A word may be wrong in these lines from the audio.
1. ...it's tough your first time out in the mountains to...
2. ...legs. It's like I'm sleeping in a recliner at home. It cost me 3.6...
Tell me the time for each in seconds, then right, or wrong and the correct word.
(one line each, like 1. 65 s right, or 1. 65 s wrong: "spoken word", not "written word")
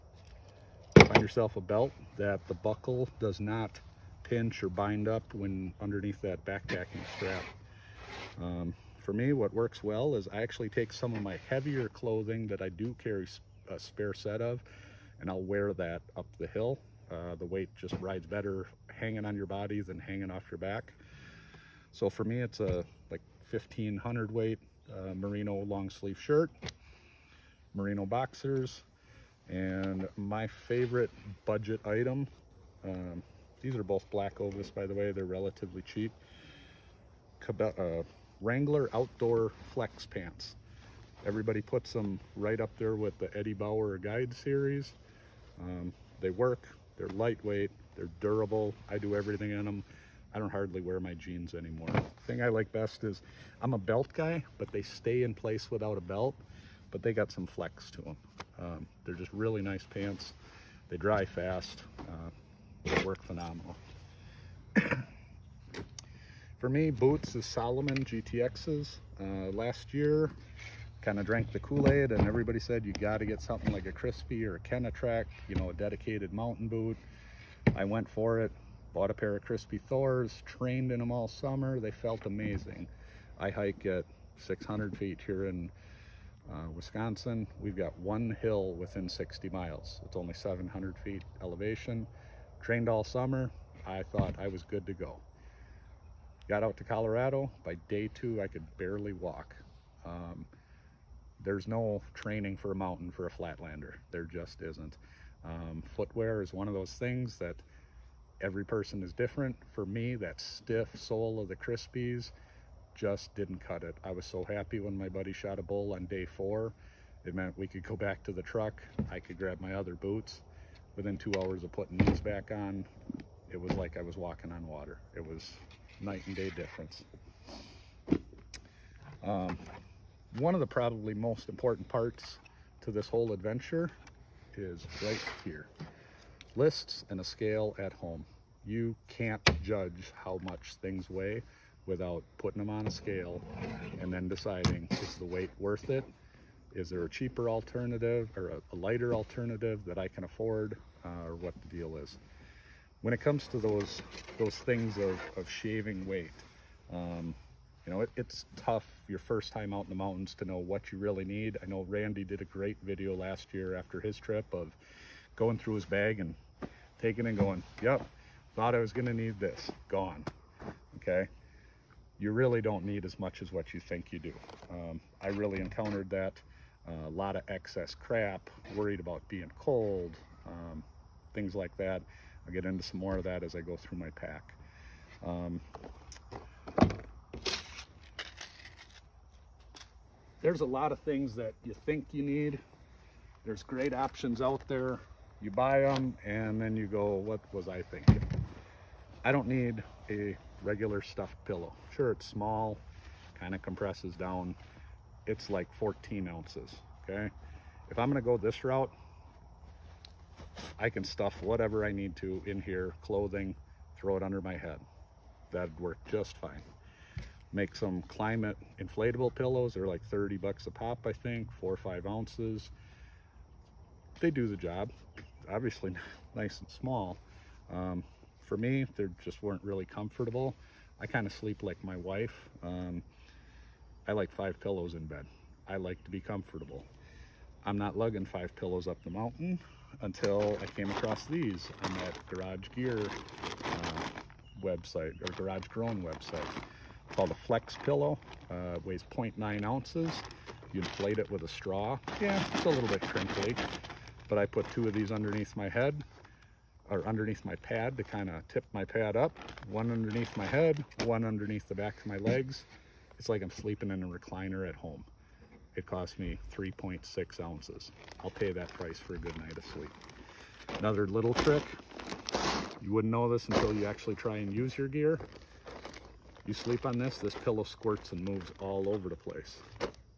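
1. 158 s right
2. 262 s right.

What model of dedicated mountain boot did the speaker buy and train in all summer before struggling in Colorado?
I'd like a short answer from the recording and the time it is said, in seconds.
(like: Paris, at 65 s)
Crispi Thors, at 79 s.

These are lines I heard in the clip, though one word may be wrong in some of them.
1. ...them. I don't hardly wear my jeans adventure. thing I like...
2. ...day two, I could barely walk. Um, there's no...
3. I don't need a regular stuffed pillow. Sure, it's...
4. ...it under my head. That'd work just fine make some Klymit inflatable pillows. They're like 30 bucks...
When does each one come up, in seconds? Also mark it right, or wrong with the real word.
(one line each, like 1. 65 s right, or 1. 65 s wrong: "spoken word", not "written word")
1. 49 s wrong: "anymore", not "adventure"
2. 97 s right
3. 199 s right
4. 214 s right.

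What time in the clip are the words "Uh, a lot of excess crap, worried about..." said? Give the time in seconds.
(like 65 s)
176 s.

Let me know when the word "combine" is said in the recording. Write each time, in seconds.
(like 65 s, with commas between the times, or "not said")
not said.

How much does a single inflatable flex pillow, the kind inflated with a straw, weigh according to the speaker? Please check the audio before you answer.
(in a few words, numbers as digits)
0.9 ounces.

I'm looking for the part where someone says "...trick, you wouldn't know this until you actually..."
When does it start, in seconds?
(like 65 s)
271 s.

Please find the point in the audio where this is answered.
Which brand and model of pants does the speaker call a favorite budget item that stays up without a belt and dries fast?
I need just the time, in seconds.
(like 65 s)
38 s.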